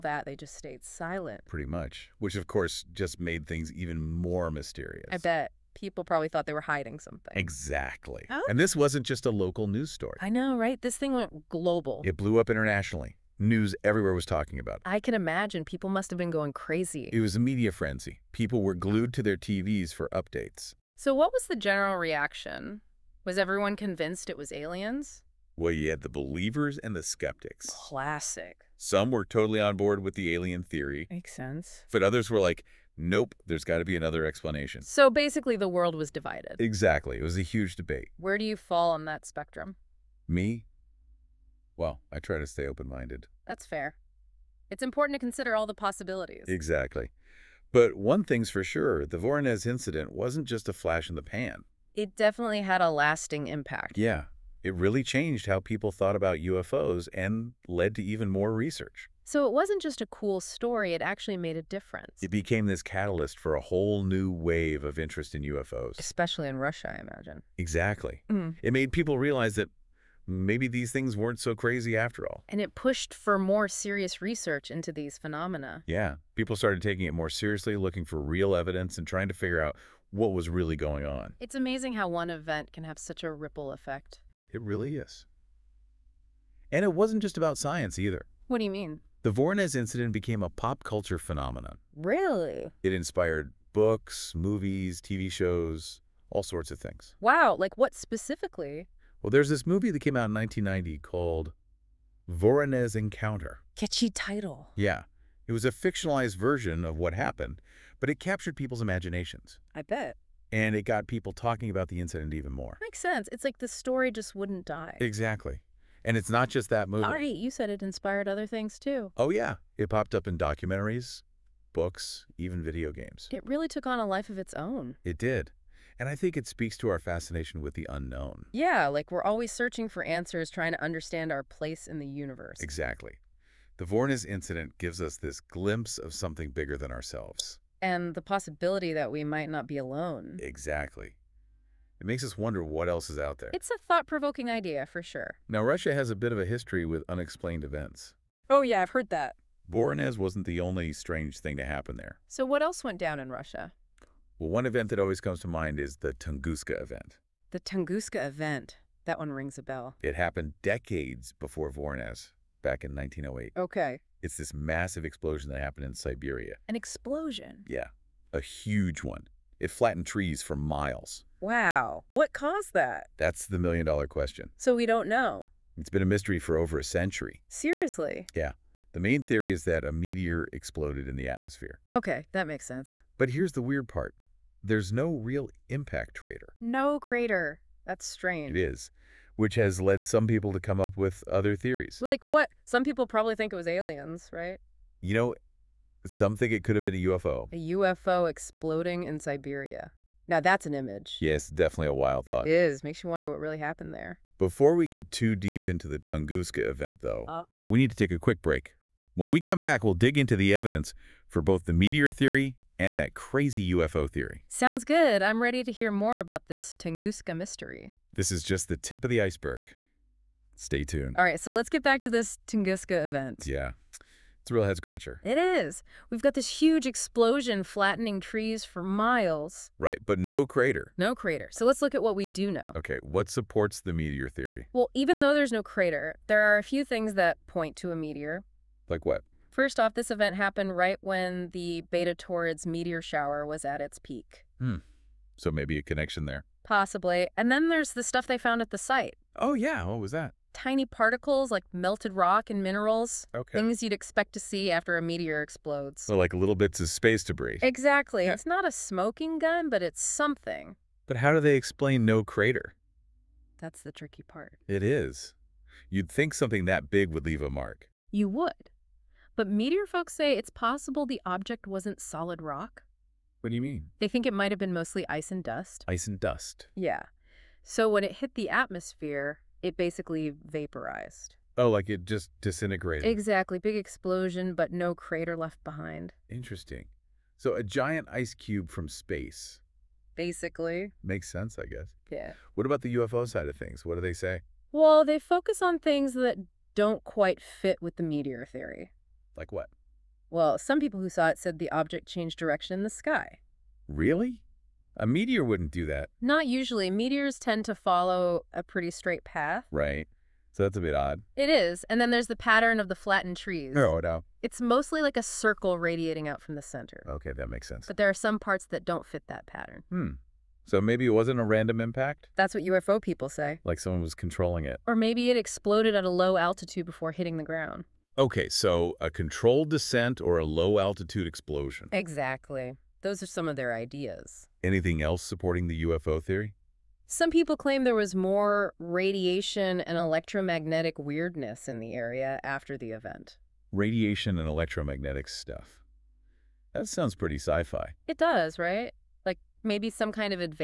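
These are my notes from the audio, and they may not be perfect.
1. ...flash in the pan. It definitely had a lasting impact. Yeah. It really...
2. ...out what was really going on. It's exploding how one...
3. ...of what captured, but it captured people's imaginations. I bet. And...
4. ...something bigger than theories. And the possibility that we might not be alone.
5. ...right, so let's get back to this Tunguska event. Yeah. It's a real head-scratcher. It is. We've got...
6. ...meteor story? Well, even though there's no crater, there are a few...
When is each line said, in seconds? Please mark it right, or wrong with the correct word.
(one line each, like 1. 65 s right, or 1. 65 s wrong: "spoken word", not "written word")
1. 50 s right
2. 79 s wrong: "amazing", not "exploding"
3. 106 s wrong: "happened", not "captured"
4. 136 s wrong: "ourselves", not "theories"
5. 221 s right
6. 233 s wrong: "theory", not "story".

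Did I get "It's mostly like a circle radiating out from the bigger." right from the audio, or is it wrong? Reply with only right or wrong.
wrong.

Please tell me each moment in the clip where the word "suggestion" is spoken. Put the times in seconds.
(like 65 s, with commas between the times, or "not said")
not said.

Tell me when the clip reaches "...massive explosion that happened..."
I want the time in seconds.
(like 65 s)
164 s.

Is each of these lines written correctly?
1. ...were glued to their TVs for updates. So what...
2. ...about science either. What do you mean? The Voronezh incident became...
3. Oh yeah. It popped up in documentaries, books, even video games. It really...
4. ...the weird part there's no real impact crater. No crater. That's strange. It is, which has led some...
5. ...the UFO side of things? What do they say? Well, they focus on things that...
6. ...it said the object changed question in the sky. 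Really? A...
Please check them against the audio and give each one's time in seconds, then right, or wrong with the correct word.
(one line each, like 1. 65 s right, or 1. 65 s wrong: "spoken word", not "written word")
1. 18 s right
2. 87 s right
3. 119 s right
4. 183 s right
5. 292 s right
6. 301 s wrong: "direction", not "question".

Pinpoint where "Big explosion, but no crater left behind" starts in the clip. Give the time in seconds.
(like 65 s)
283 s.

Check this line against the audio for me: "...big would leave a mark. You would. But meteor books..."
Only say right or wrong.
wrong.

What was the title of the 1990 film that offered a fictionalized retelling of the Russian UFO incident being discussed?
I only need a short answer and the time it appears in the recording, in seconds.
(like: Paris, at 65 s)
Voronezh Encounter, at 102 s.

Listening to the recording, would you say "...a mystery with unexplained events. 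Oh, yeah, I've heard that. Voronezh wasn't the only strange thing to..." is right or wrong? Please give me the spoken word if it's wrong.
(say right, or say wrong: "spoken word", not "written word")
wrong: "history", not "mystery".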